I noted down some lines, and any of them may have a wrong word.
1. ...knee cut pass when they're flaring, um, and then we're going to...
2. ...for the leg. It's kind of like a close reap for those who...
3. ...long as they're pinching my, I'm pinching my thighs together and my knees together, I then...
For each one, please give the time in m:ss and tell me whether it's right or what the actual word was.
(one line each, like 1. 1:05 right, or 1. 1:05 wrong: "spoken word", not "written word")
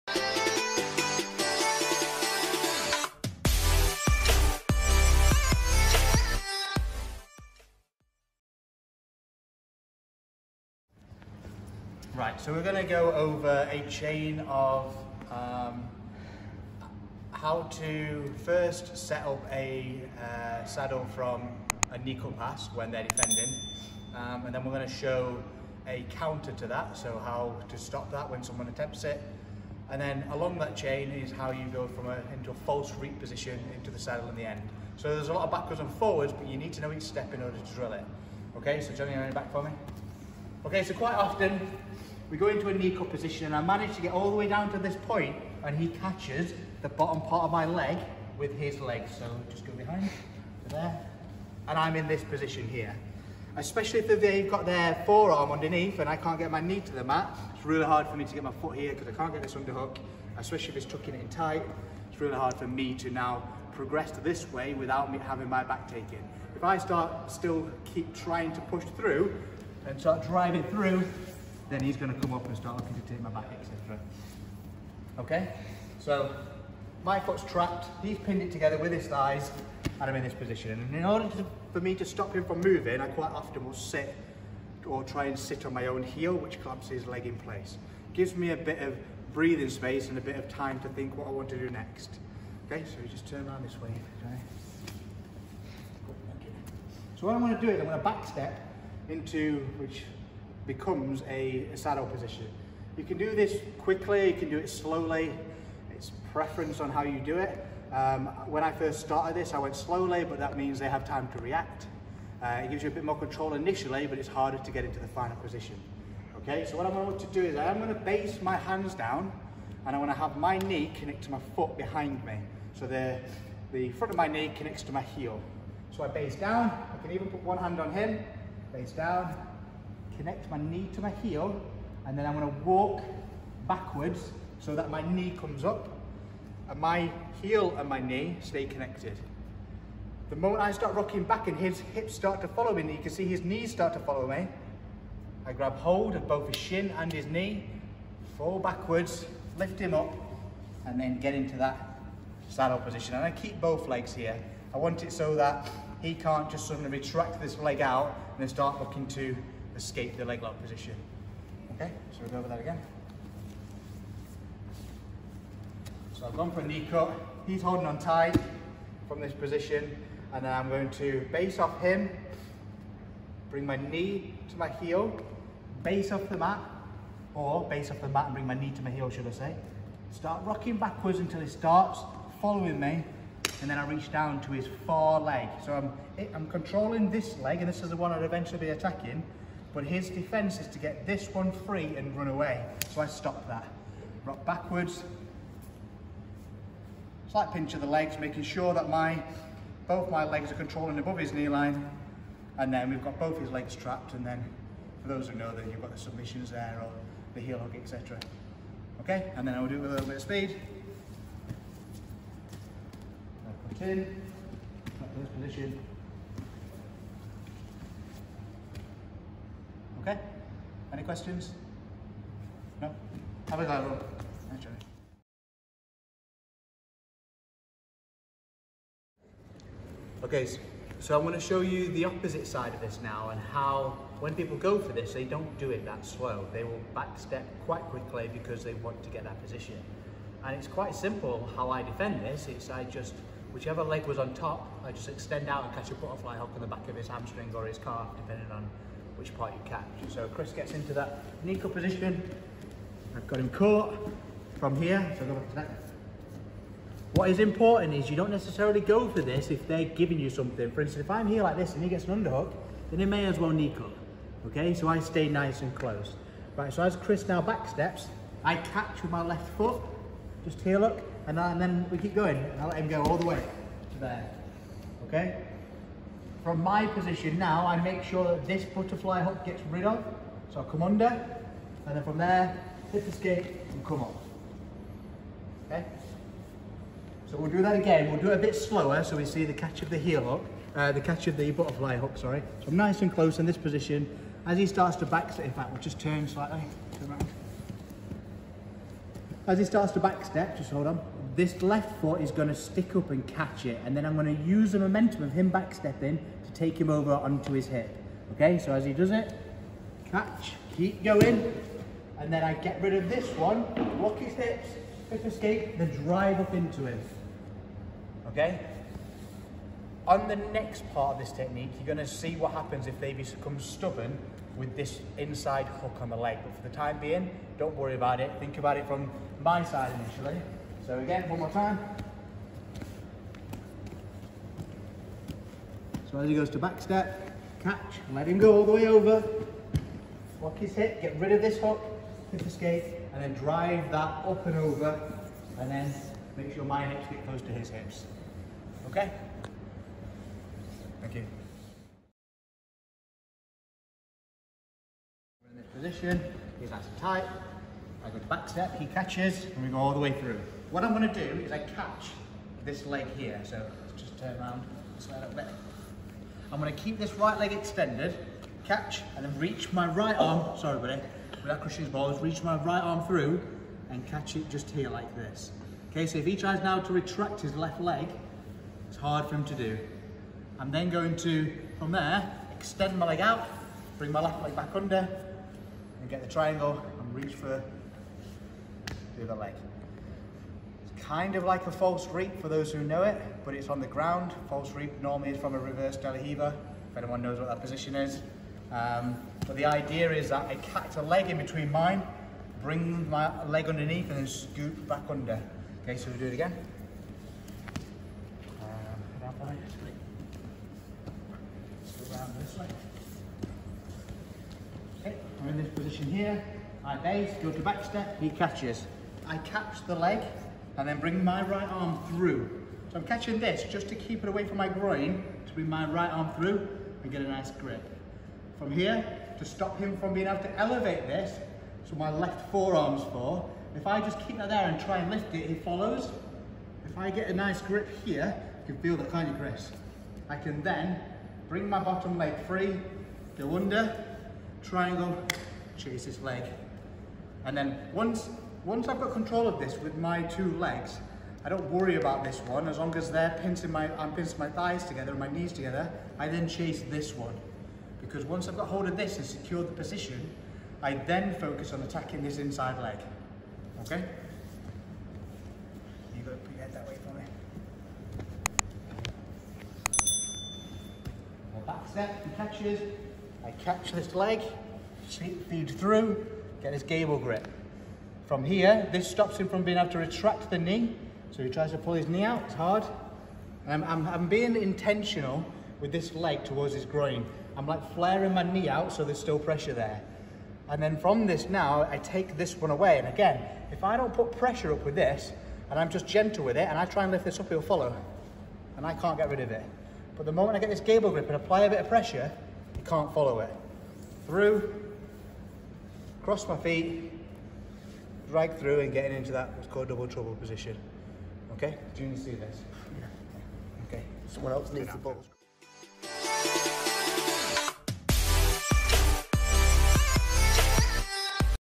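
1. 0:21 wrong: "defending", not "flaring"
2. 6:27 wrong: "false", not "close"
3. 7:32 right.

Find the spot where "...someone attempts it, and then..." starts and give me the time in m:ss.
0:28.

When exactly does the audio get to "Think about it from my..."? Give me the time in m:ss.
5:28.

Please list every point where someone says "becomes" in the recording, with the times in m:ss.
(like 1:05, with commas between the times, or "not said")
1:40, 5:23.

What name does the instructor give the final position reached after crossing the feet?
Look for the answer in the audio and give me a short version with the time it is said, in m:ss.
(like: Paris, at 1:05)
Double trouble, at 8:29.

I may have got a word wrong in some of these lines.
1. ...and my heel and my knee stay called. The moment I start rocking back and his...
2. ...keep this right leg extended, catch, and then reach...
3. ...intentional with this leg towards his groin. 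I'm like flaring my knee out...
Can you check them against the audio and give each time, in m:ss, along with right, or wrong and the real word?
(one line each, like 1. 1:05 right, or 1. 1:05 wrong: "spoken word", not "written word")
1. 2:16 wrong: "connected", not "called"
2. 6:06 right
3. 8:04 right.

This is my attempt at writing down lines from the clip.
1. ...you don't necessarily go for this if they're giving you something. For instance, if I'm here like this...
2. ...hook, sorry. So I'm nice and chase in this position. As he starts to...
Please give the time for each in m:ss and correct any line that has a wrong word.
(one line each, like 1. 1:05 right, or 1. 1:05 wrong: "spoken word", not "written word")
1. 4:18 right
2. 4:51 wrong: "close", not "chase".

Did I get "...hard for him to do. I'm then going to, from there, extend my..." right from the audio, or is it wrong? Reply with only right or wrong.
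right.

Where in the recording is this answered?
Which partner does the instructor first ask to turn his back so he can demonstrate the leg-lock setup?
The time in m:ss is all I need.
0:38.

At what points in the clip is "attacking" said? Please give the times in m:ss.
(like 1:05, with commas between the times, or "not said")
3:08, 7:41.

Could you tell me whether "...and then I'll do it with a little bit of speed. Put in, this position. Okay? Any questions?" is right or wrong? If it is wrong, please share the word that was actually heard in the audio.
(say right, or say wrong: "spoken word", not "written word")
right.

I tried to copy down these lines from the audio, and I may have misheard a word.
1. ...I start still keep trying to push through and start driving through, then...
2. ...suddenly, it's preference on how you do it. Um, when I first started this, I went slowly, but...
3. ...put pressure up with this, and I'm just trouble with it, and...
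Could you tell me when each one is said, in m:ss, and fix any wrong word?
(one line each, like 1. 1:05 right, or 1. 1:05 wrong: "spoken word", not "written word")
1. 1:06 right
2. 1:44 wrong: "slowly", not "suddenly"
3. 8:14 wrong: "gentle", not "trouble".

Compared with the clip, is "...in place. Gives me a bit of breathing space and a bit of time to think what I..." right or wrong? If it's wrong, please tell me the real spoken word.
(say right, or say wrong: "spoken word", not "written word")
right.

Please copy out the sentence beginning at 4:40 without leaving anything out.
So I come under, and then from there, hit the skate and come up.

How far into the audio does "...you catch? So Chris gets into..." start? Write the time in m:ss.
4:09.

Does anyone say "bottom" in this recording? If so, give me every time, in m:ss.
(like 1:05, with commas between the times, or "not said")
0:46, 7:21.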